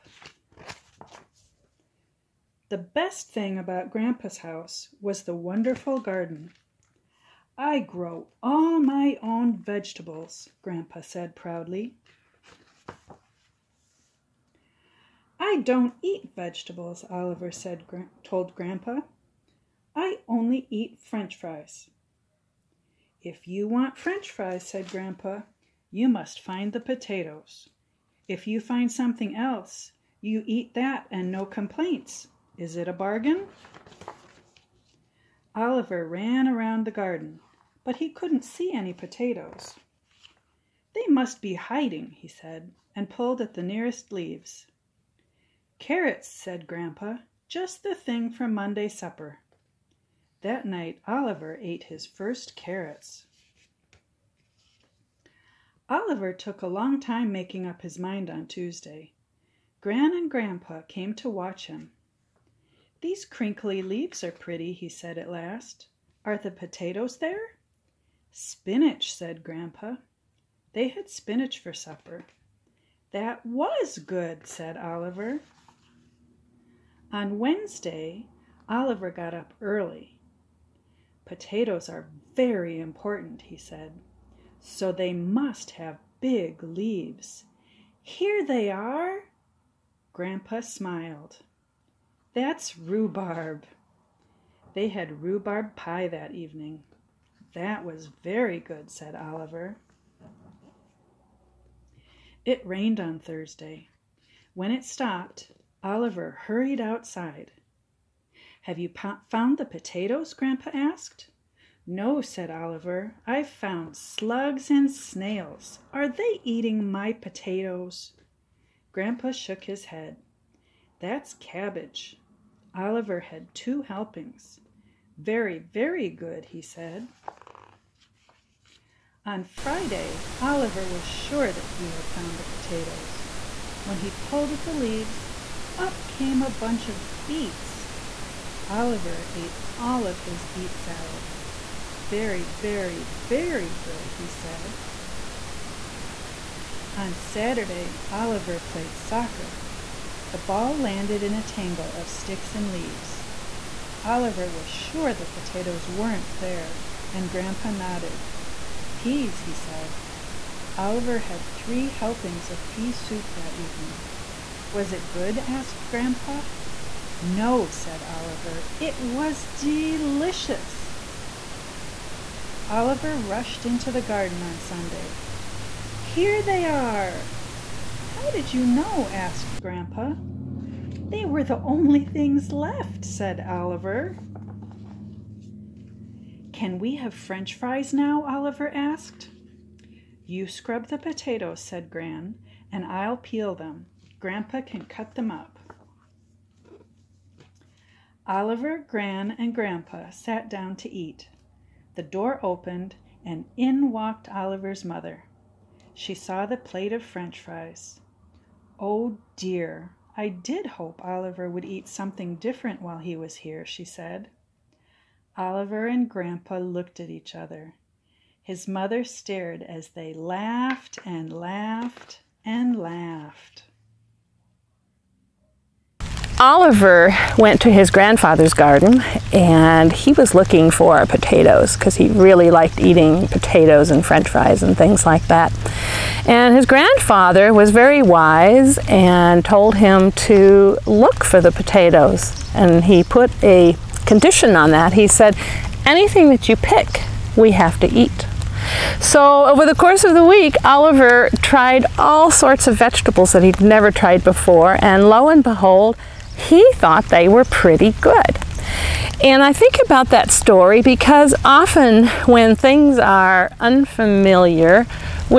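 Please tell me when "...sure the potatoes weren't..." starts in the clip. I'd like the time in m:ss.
2:34.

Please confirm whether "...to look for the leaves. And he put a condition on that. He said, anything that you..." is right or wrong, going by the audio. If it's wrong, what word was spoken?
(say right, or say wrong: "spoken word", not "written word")
wrong: "potatoes", not "leaves".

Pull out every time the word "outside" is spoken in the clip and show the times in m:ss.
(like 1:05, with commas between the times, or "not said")
1:46.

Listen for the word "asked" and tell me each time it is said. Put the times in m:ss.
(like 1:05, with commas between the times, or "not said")
1:50, 2:45, 2:59, 3:08.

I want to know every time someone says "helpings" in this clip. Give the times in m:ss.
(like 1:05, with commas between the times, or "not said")
2:03, 2:41.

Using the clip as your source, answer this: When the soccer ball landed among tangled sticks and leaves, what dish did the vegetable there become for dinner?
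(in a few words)
Pea soup.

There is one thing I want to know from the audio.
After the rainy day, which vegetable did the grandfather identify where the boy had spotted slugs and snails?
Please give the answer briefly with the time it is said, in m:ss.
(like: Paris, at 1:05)
Cabbage, at 2:01.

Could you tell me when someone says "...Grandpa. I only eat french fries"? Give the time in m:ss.
0:18.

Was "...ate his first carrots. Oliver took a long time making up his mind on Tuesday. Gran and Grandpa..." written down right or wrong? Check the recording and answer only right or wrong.
right.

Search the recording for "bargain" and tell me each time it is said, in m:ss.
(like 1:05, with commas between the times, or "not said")
0:32.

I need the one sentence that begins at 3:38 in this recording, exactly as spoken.
His mother stared as they laughed and laughed.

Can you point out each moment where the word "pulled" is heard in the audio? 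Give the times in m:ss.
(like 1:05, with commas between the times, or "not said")
0:43, 2:14.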